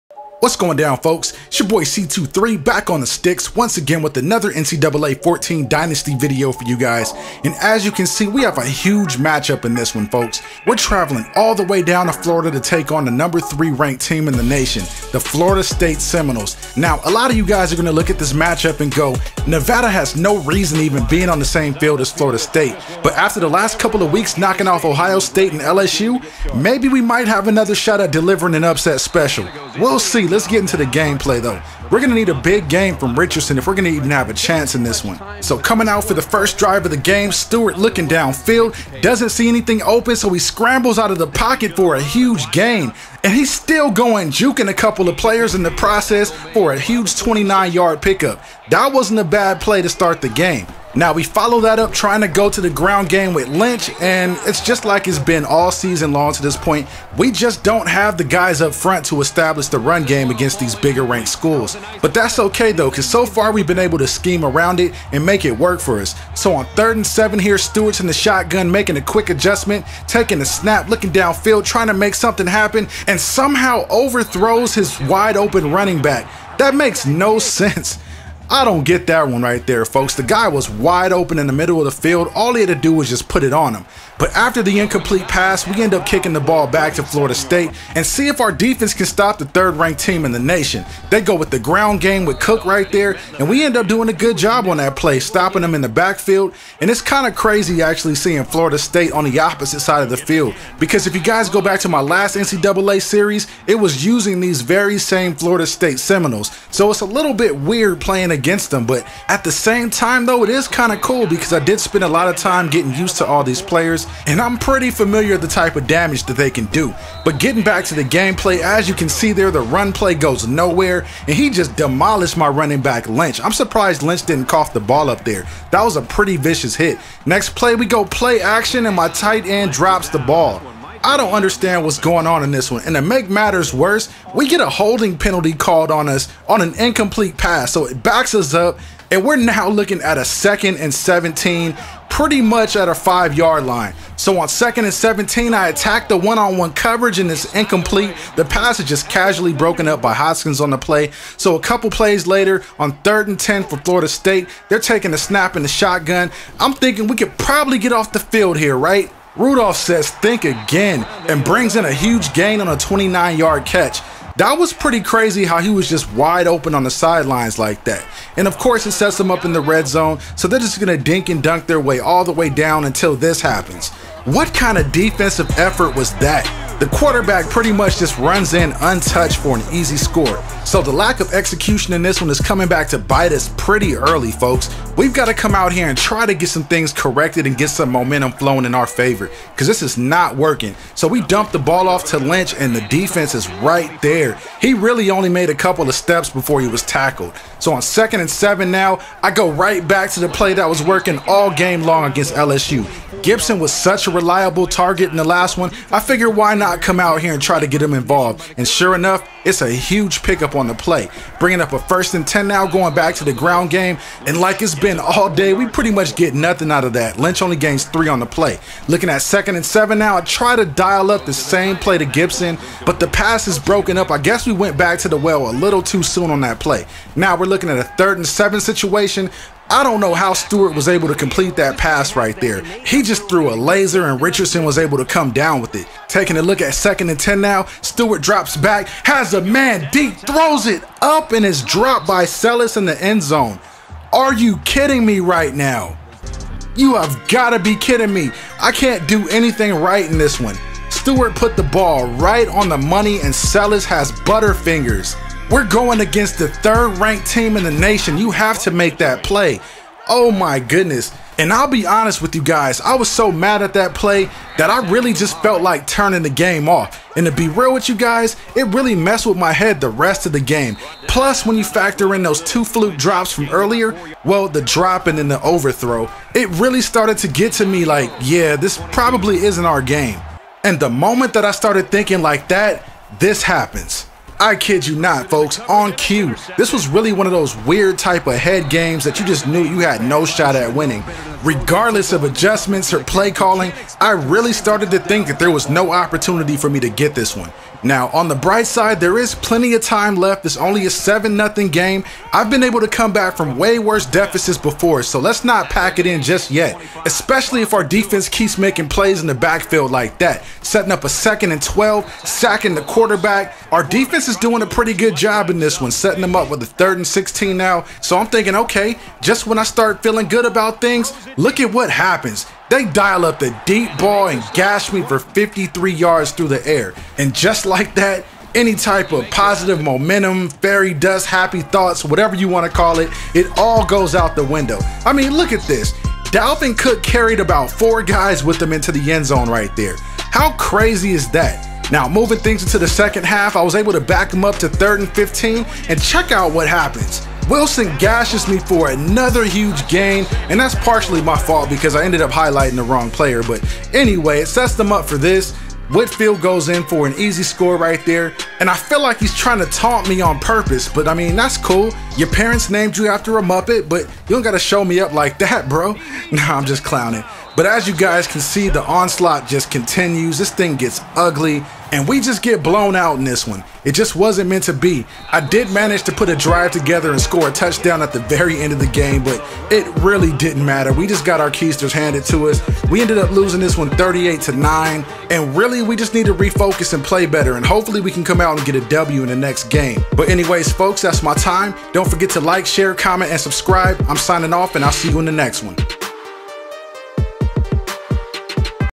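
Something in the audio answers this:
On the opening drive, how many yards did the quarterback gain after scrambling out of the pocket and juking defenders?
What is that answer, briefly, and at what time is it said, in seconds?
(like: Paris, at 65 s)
29, at 47 s.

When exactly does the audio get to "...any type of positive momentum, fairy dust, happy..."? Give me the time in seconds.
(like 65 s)
328 s.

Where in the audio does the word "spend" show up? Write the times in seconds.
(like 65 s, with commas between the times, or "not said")
111 s.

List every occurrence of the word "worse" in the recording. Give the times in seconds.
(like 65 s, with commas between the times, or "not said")
133 s, 303 s.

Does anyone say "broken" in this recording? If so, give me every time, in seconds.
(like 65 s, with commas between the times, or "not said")
149 s, 223 s.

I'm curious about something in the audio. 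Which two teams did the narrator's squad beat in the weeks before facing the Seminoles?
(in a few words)
Ohio State and LSU.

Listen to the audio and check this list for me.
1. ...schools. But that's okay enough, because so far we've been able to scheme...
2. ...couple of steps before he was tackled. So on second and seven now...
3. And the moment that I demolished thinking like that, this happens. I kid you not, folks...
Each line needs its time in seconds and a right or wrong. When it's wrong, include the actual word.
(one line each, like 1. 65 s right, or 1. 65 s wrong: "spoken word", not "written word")
1. 61 s wrong: "though", not "enough"
2. 195 s right
3. 280 s wrong: "started", not "demolished".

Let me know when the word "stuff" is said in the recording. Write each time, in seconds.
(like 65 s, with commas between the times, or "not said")
not said.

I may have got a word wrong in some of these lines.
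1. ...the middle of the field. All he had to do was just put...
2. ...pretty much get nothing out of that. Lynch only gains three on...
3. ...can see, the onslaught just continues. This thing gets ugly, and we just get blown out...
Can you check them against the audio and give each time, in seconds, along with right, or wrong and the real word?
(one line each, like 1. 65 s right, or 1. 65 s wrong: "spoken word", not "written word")
1. 81 s right
2. 215 s right
3. 368 s right.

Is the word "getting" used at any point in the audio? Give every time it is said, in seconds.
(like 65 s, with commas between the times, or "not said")
112 s, 117 s.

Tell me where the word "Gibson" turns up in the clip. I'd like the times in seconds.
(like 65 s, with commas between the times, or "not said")
203 s, 222 s.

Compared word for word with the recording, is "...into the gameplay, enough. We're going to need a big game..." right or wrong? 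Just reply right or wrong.
wrong.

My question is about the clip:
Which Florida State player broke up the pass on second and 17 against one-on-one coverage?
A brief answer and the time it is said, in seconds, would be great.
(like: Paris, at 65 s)
Hoskins, at 150 s.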